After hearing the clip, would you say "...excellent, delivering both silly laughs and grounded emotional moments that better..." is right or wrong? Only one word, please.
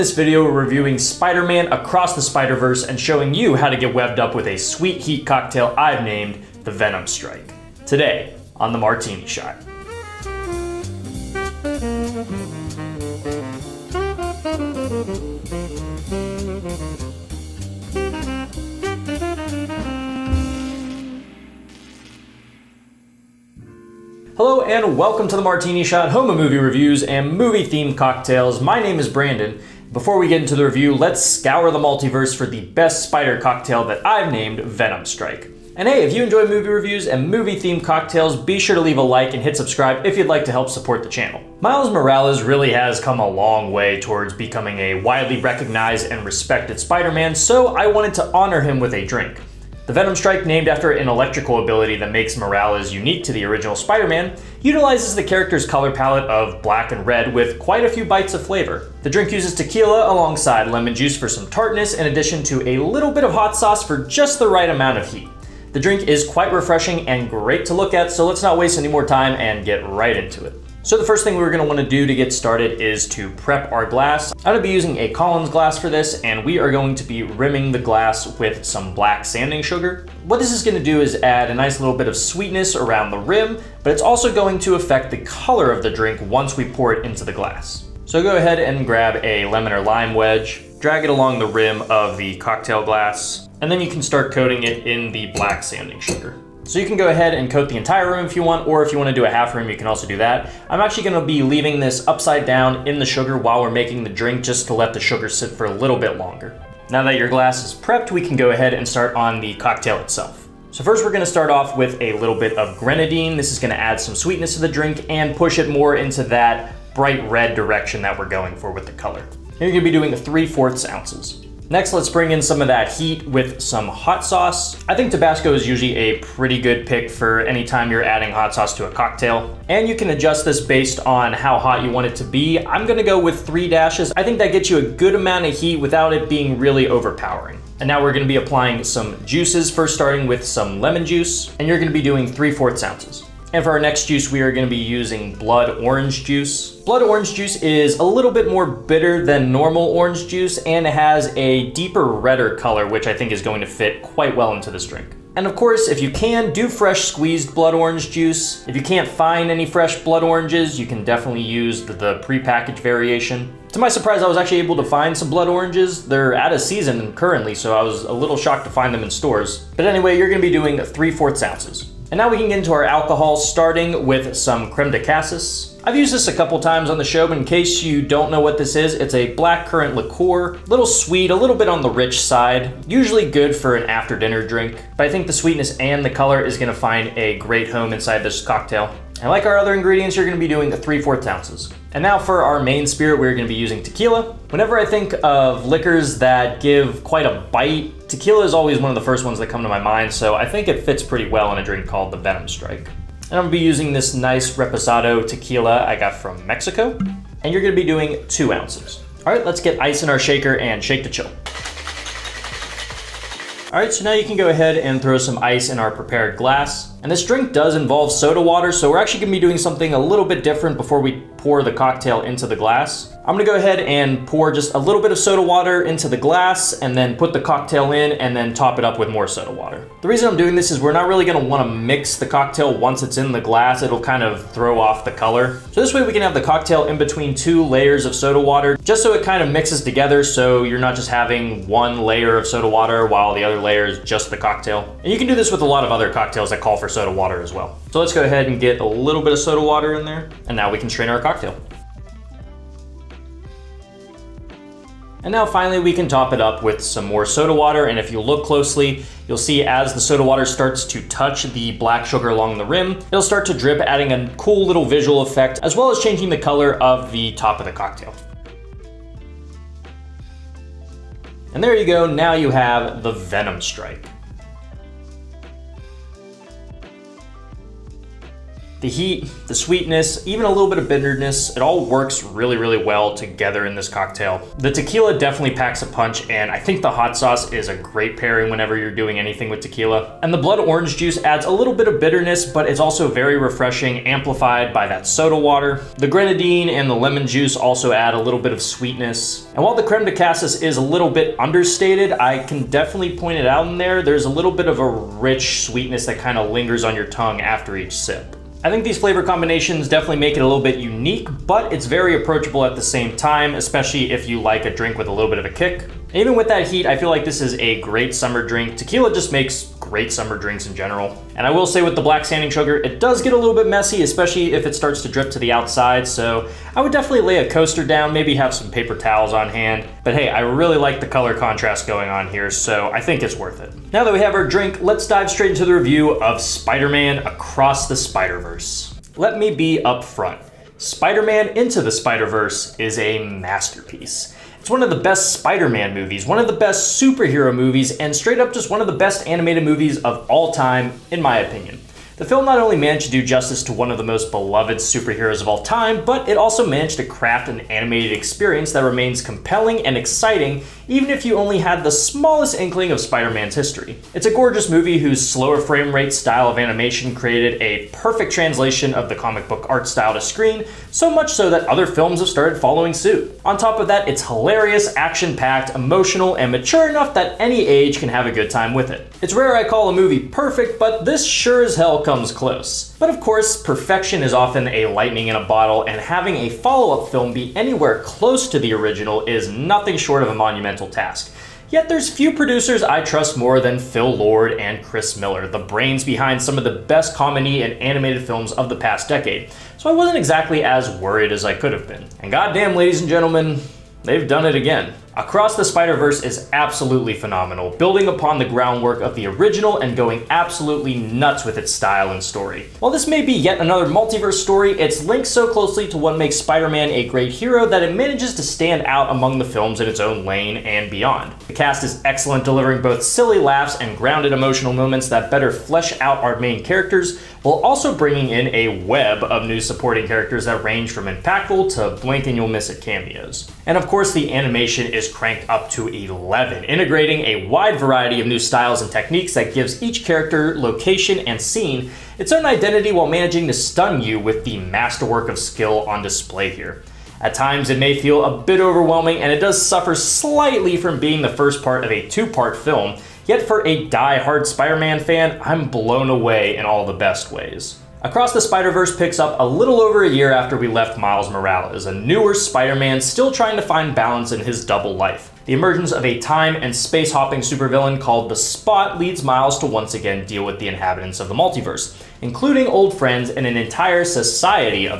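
right.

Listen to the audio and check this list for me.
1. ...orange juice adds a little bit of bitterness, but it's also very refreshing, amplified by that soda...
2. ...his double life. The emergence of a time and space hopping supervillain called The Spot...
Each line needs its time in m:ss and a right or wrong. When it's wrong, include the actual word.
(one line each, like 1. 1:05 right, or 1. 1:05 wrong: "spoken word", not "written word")
1. 4:50 right
2. 7:44 right.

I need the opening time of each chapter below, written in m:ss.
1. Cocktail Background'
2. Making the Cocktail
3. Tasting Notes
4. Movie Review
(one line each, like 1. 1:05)
1. 0:41
2. 1:10
3. 4:38
4. 5:38.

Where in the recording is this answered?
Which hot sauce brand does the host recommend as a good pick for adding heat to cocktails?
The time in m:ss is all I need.
2:05.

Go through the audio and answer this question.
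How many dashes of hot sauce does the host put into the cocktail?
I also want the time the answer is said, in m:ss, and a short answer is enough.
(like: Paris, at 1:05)
3, at 2:13.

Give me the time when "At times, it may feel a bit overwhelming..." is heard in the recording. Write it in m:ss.
7:27.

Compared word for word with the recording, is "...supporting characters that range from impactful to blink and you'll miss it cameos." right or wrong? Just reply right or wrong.
right.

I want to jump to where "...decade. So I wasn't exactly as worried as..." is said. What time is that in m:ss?
6:39.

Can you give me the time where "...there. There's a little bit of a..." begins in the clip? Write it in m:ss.
5:03.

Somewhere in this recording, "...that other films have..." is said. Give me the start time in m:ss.
6:11.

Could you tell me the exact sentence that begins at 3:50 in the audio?
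The reason I'm doing this is we're not really gonna wanna mix the cocktail once it's in the glass.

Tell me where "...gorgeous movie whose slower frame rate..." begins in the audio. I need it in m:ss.
6:04.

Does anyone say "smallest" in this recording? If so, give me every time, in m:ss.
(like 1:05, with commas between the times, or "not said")
6:01.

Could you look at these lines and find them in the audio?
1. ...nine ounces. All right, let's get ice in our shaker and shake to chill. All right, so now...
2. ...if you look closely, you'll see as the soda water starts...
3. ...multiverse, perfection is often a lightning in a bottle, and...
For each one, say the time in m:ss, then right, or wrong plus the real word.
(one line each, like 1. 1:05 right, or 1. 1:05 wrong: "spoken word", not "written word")
1. 3:28 wrong: "two", not "nine"
2. 4:17 right
3. 6:23 wrong: "course", not "multiverse".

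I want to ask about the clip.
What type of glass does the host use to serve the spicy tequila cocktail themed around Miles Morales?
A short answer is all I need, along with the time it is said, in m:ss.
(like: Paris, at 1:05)
Collins glass, at 1:15.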